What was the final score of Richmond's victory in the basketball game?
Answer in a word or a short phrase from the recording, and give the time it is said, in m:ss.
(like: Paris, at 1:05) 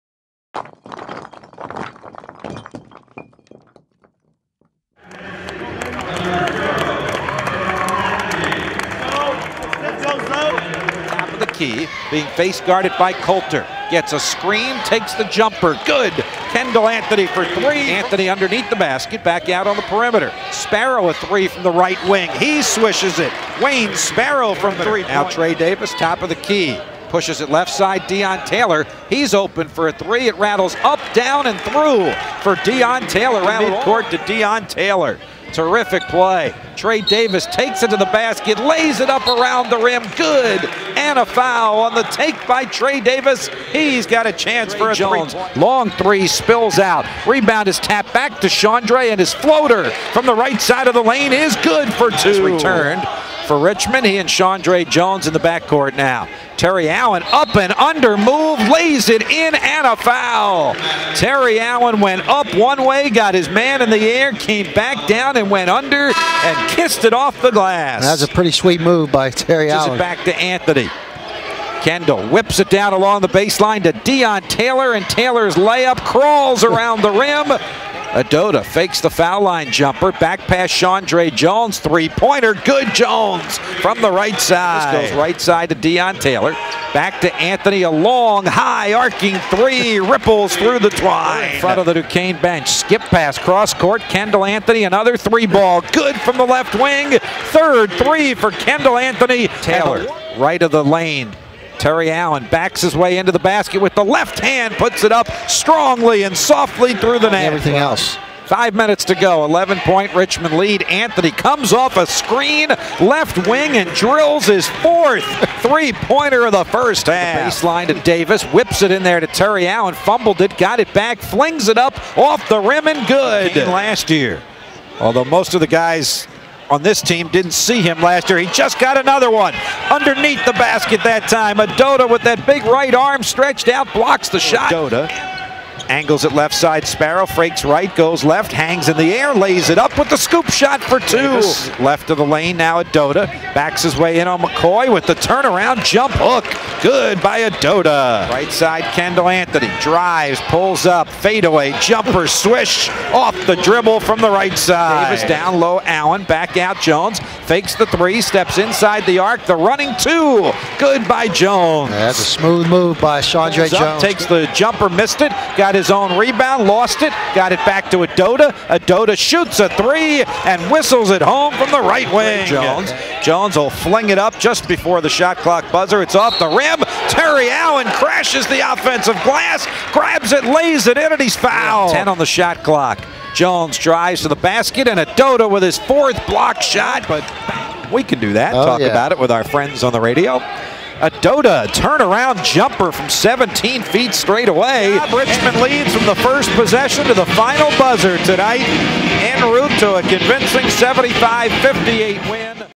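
75-58, at 3:20.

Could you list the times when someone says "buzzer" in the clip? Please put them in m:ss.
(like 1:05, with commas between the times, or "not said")
2:55, 3:17.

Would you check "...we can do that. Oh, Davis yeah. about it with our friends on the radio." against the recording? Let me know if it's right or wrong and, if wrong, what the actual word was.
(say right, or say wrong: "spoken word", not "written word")
wrong: "Talk", not "Davis".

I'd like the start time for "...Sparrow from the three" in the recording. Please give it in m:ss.
0:23.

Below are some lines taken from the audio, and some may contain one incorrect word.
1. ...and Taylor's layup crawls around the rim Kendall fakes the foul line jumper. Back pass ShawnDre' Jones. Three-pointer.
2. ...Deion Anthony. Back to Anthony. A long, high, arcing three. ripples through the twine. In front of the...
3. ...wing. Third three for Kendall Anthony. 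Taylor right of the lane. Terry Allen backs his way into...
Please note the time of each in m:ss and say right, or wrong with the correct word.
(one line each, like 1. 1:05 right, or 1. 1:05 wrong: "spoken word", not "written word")
1. 1:14 wrong: "Ododa", not "Kendall"
2. 1:25 wrong: "Taylor", not "Anthony"
3. 1:36 right.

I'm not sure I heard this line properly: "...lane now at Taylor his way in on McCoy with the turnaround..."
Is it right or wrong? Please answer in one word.
wrong.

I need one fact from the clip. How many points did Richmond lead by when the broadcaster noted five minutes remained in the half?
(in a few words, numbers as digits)
11.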